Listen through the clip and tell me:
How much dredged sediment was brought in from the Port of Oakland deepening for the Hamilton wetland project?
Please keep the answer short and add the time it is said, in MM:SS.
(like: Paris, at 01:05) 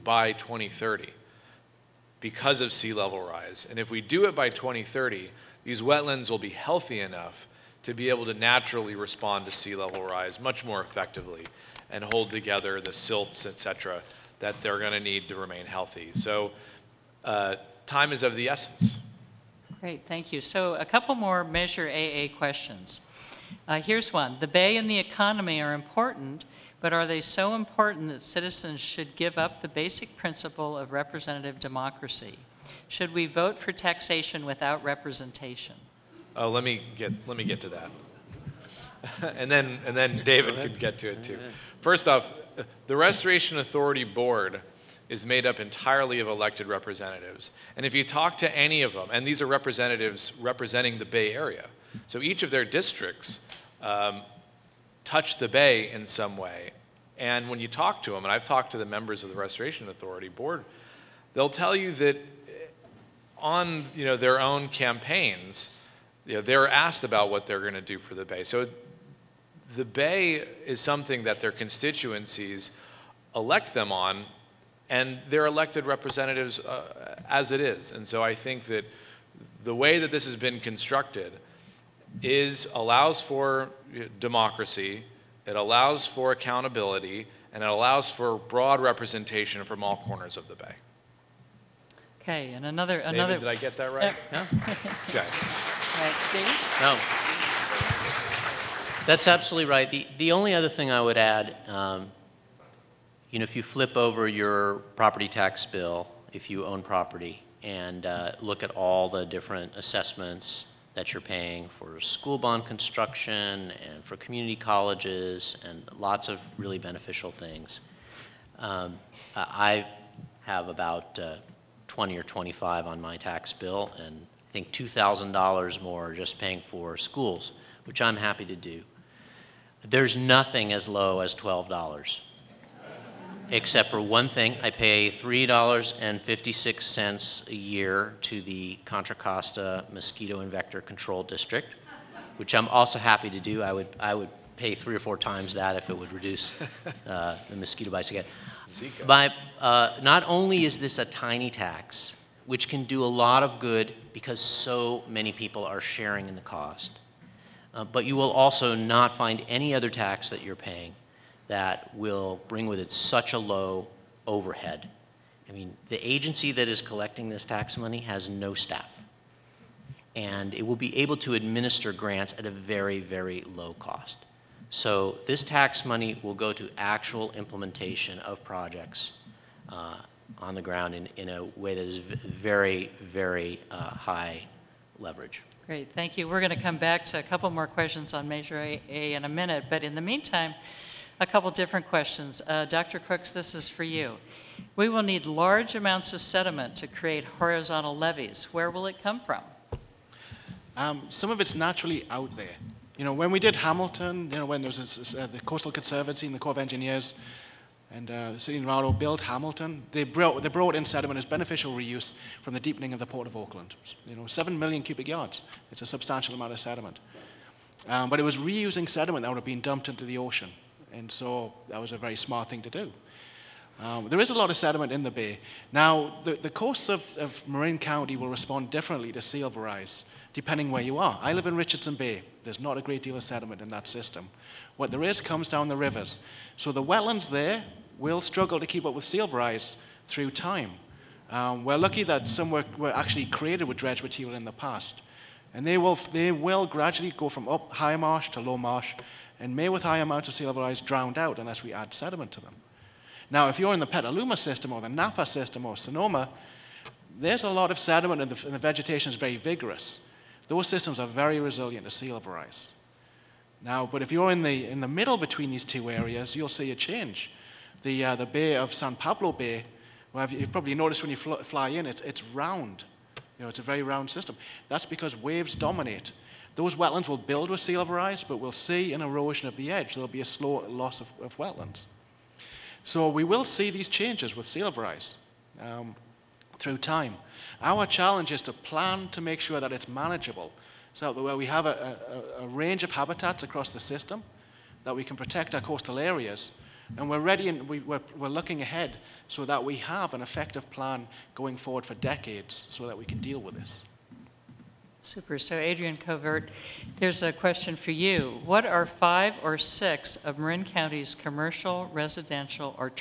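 7 million cubic yards, at 03:34.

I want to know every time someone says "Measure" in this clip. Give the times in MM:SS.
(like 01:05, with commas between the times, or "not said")
00:21, 03:08.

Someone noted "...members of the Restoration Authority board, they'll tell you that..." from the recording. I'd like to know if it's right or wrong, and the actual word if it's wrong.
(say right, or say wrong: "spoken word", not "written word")
right.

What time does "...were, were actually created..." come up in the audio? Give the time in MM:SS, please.
04:02.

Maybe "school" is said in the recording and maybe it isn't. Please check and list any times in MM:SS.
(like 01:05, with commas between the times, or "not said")
01:52, 02:06.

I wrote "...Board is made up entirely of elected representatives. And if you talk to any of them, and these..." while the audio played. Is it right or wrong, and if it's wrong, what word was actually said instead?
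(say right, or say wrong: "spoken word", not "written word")
right.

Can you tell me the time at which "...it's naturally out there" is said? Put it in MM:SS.
03:21.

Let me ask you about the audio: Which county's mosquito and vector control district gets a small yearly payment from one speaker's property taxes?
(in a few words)
Contra Costa.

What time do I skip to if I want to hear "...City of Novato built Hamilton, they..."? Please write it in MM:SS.
03:28.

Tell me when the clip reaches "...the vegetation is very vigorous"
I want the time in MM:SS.
04:18.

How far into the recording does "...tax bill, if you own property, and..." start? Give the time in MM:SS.
01:45.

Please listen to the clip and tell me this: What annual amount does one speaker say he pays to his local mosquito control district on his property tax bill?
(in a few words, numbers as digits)
$3.56.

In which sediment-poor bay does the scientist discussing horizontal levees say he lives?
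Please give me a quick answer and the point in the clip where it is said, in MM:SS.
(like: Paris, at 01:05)
Richardson Bay, at 03:51.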